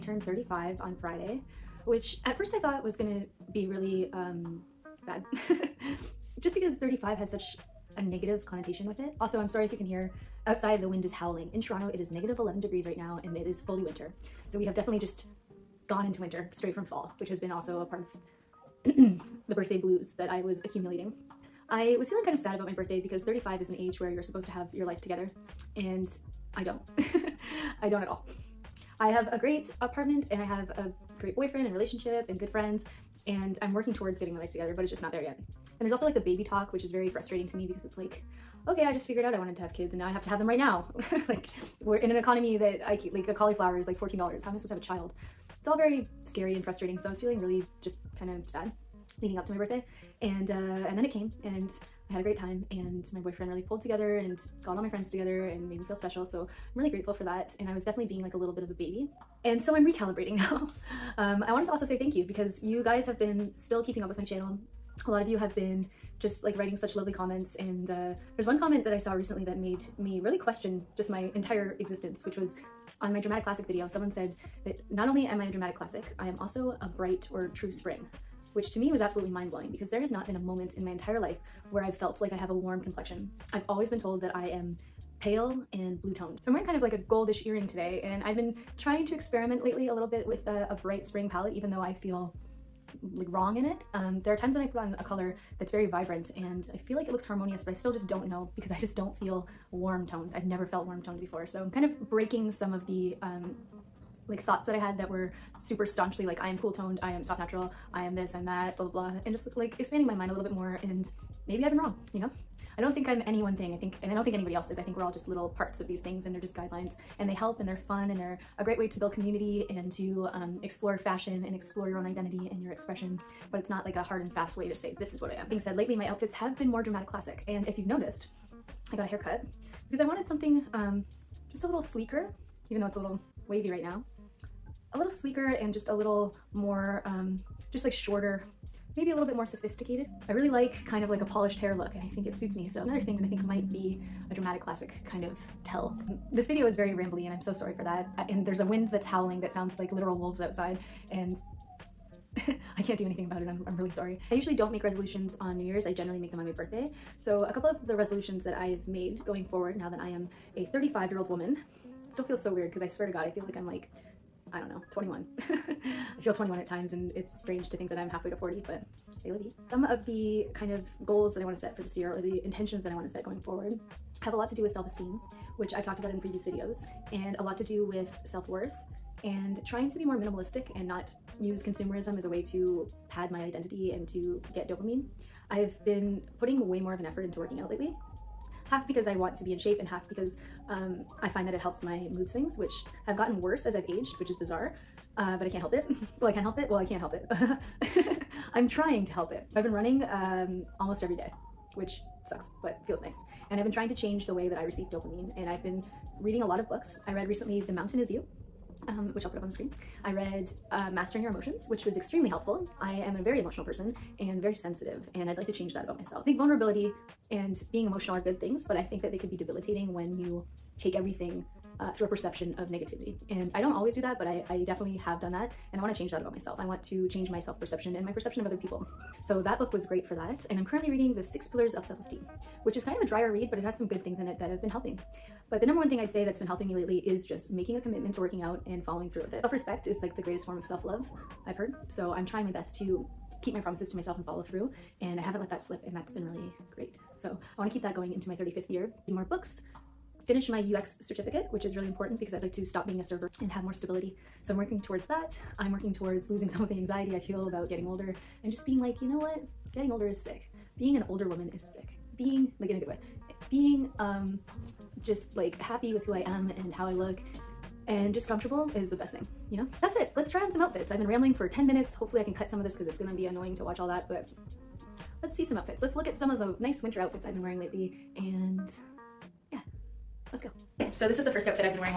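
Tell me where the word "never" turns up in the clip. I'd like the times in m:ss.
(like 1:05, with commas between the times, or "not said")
1:40.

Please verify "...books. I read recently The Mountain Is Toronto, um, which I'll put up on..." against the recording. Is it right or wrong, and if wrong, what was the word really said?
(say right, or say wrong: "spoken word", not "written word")
wrong: "You", not "Toronto".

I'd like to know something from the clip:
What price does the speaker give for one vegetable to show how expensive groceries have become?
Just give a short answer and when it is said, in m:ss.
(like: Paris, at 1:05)
$14, at 0:43.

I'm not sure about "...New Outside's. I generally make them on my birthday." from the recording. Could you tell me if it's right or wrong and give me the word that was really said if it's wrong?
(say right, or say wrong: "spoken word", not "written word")
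wrong: "Year", not "Outside".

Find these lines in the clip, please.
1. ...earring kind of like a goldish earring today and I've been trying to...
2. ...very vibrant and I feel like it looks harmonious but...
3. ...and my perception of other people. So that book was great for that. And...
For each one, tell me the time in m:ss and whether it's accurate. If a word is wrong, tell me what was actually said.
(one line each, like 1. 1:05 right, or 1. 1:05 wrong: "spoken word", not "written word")
1. 1:26 wrong: "wearing", not "earring"
2. 1:35 right
3. 3:47 right.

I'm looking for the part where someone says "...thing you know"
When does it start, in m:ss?
4:29.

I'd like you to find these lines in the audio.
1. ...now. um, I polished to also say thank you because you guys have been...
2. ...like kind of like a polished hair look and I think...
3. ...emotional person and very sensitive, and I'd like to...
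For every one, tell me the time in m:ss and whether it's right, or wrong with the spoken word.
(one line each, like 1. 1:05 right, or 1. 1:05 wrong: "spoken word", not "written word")
1. 1:00 wrong: "wanted", not "polished"
2. 2:20 right
3. 3:33 right.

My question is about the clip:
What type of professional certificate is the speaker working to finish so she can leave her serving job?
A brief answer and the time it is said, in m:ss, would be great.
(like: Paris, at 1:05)
UX certificate, at 4:10.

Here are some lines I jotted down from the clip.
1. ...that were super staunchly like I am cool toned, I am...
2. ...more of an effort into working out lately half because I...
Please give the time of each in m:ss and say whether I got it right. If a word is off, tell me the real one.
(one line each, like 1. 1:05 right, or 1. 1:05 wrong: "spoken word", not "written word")
1. 1:44 right
2. 3:06 right.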